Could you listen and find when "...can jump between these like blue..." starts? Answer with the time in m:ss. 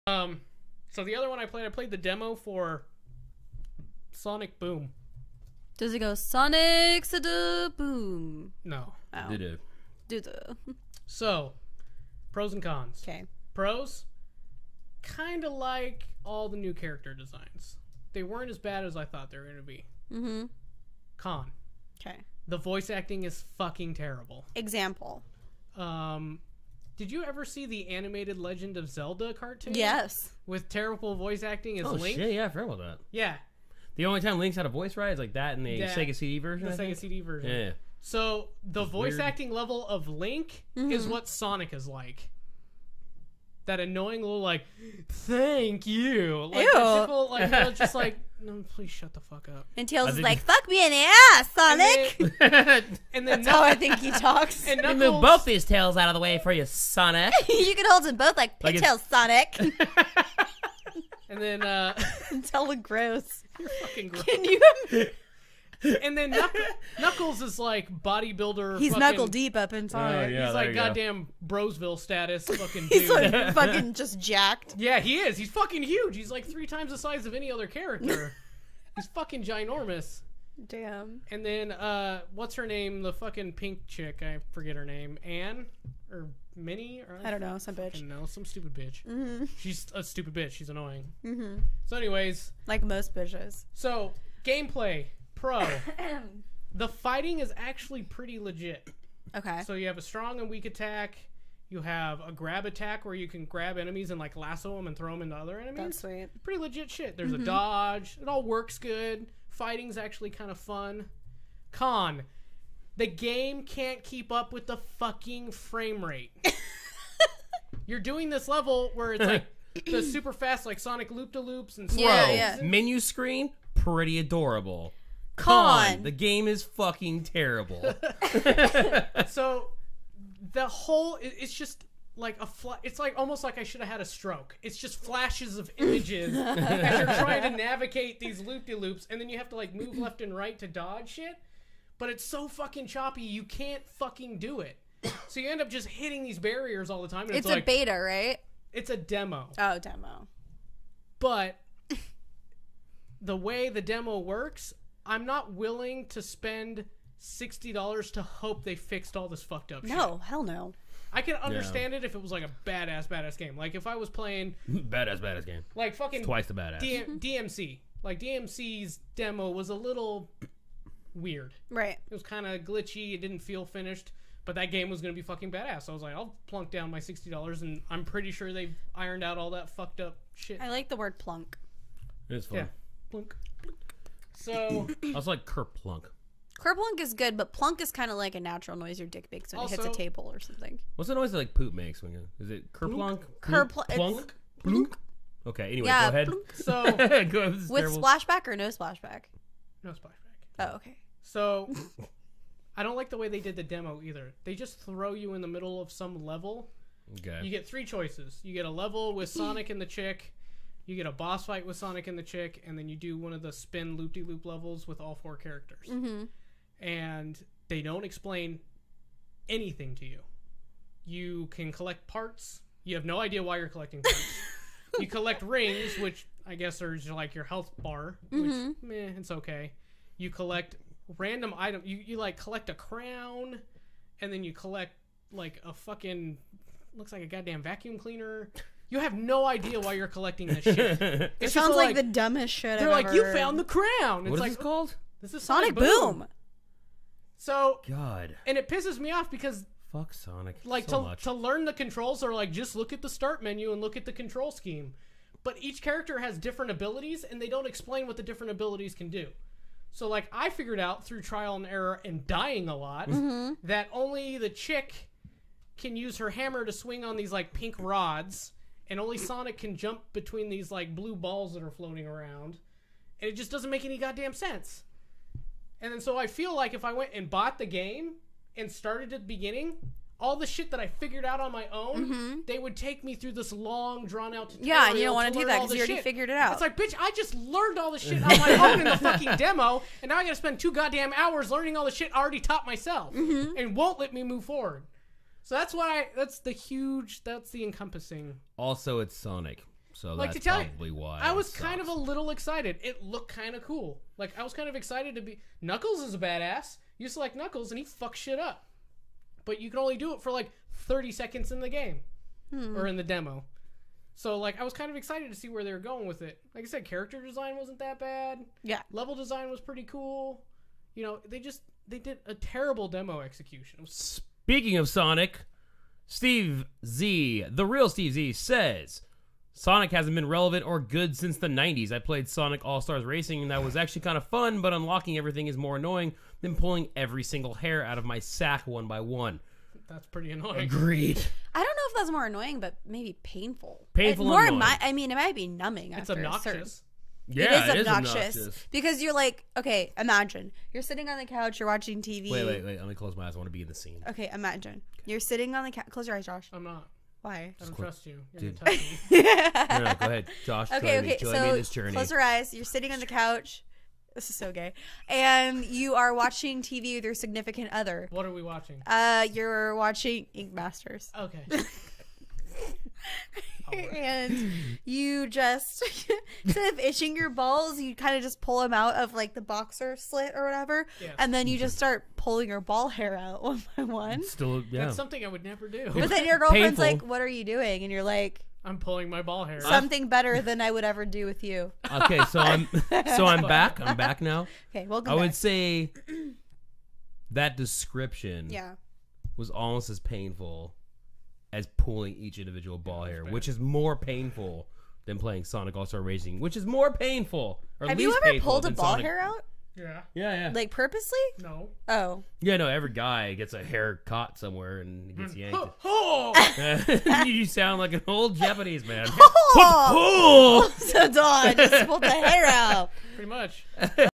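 4:29.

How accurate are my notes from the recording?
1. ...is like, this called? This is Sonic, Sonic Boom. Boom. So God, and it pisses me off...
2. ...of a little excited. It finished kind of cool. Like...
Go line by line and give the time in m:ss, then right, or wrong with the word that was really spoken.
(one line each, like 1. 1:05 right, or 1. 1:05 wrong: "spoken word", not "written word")
1. 4:04 right
2. 5:01 wrong: "looked", not "finished".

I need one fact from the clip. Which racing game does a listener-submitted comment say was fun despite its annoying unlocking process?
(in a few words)
Sonic All Stars Racing.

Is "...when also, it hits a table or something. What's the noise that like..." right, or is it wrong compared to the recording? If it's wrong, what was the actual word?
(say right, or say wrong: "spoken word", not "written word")
right.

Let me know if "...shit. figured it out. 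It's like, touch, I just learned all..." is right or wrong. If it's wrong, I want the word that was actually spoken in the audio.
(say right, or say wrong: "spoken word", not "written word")
wrong: "bitch", not "touch".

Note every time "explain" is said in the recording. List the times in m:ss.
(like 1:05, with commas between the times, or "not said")
3:38, 4:17.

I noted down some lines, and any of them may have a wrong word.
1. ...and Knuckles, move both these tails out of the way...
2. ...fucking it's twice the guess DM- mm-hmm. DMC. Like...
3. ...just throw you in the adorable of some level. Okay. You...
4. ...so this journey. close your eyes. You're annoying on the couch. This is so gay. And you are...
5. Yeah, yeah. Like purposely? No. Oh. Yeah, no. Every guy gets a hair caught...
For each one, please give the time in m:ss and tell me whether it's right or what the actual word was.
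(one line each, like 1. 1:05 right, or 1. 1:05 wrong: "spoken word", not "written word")
1. 0:54 right
2. 2:45 wrong: "badass", not "guess"
3. 3:24 wrong: "middle", not "adorable"
4. 6:01 wrong: "sitting", not "annoying"
5. 6:50 right.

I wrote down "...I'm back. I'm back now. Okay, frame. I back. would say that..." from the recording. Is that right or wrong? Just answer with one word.
wrong.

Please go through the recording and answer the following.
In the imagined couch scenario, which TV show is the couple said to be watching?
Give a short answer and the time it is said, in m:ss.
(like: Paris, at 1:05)
Ink Masters, at 6:10.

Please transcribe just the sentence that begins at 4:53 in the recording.
and won't let me move forward.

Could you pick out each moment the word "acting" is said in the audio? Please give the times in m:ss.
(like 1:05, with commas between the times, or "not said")
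0:22, 0:31, 0:39.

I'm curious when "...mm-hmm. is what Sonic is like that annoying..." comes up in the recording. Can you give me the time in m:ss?
0:40.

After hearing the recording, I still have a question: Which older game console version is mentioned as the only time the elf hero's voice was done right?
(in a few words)
Sega CD.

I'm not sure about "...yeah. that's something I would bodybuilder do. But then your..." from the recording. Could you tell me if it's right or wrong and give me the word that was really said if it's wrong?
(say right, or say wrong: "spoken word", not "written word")
wrong: "never", not "bodybuilder".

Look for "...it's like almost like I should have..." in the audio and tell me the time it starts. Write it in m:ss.
2:12.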